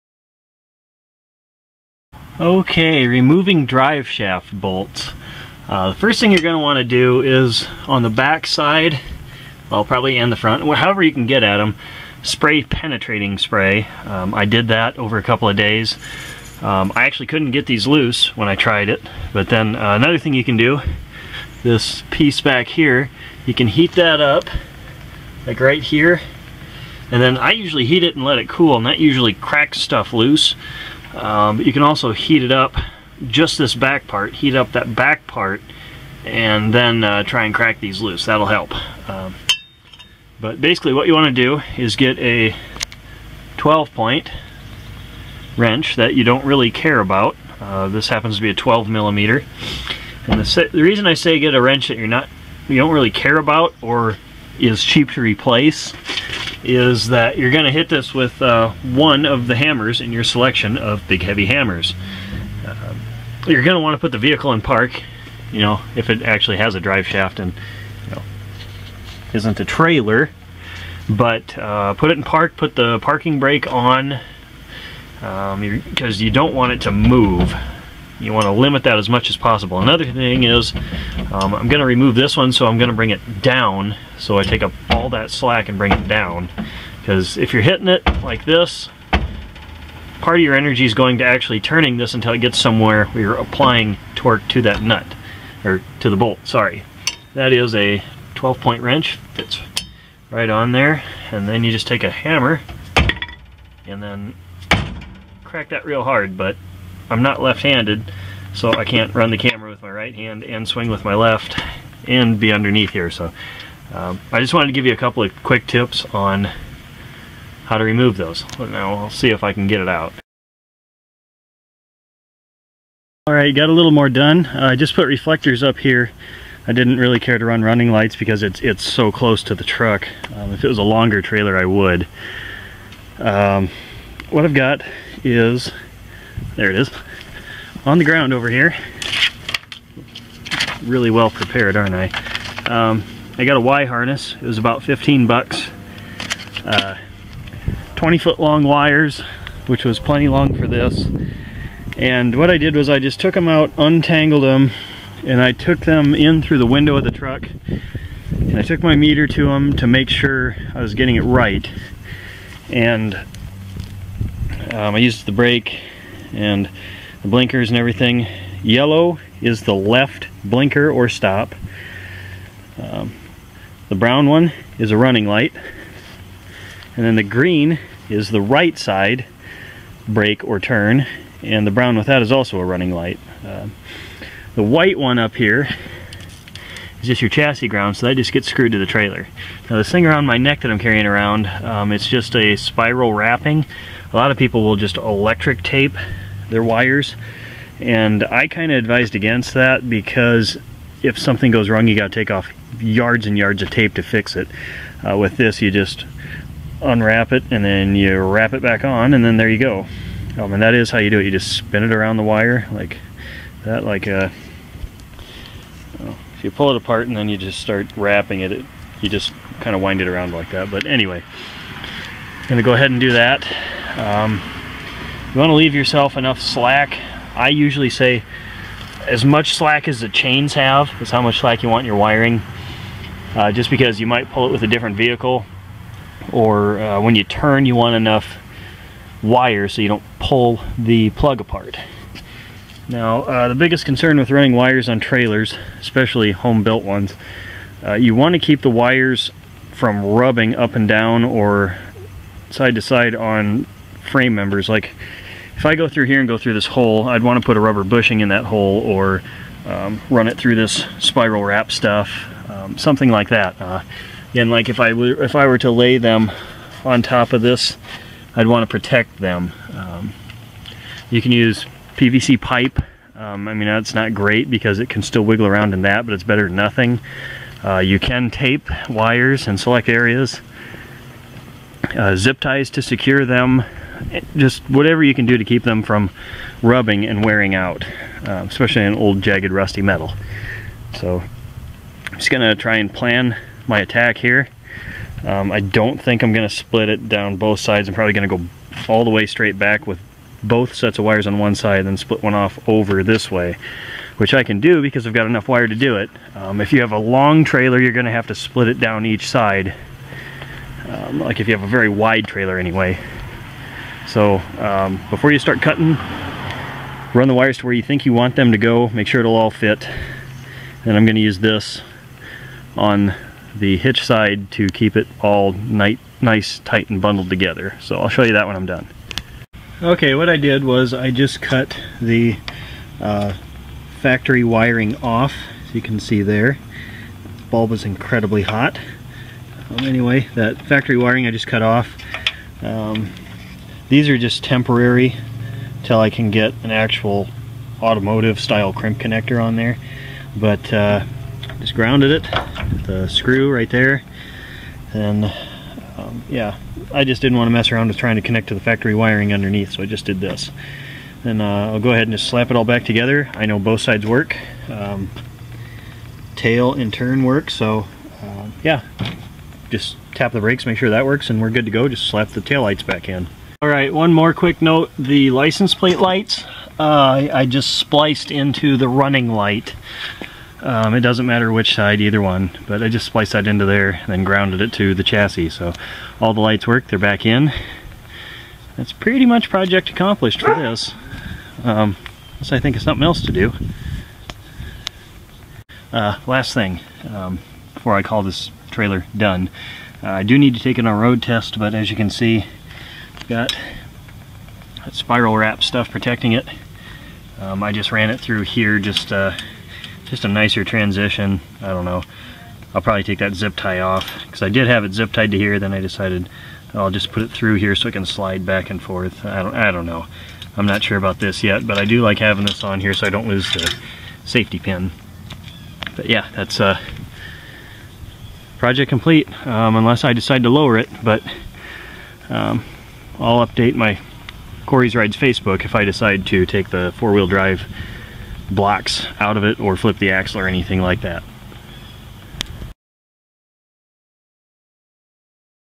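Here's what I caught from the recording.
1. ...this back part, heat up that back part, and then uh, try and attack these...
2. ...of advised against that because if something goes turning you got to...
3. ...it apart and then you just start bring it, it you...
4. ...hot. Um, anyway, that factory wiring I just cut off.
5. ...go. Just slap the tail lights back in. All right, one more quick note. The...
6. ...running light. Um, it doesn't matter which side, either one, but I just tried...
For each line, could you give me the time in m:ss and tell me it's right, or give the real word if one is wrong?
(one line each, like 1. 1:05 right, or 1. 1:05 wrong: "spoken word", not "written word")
1. 0:33 wrong: "crack", not "attack"
2. 3:18 wrong: "wrong", not "turning"
3. 3:36 wrong: "wrapping", not "bring"
4. 5:38 right
5. 6:11 right
6. 6:18 wrong: "spliced", not "tried".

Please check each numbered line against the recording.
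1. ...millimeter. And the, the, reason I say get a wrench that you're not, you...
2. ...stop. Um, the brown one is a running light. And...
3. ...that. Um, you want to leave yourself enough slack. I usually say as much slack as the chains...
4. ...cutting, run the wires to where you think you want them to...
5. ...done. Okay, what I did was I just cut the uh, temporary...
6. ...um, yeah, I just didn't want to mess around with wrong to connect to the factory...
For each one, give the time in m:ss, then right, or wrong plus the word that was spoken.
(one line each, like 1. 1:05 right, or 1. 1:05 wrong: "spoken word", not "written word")
1. 0:48 right
2. 2:51 right
3. 3:43 right
4. 5:15 right
5. 5:28 wrong: "factory", not "temporary"
6. 5:55 wrong: "trying", not "wrong".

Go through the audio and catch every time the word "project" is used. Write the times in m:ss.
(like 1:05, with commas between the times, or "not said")
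6:29, 7:08.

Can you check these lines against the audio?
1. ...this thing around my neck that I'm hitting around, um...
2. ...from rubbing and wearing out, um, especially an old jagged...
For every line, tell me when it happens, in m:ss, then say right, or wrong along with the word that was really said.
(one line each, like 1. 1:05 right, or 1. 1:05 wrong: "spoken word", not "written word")
1. 3:09 wrong: "carrying", not "hitting"
2. 4:45 right.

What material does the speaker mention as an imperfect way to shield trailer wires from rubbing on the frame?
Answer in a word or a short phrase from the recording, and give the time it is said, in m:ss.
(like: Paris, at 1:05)
PVC pipe, at 4:31.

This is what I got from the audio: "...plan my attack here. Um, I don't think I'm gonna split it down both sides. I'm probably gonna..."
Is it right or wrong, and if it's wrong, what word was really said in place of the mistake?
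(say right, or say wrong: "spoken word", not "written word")
right.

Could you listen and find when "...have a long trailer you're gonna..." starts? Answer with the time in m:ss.
5:06.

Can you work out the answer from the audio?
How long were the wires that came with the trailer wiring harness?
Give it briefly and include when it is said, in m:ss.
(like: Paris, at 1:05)
20 feet, at 2:27.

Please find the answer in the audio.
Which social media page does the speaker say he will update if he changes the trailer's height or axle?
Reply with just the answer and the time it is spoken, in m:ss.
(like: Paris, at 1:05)
Kory's Rides Facebook, at 7:14.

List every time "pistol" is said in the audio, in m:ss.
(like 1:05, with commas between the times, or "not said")
not said.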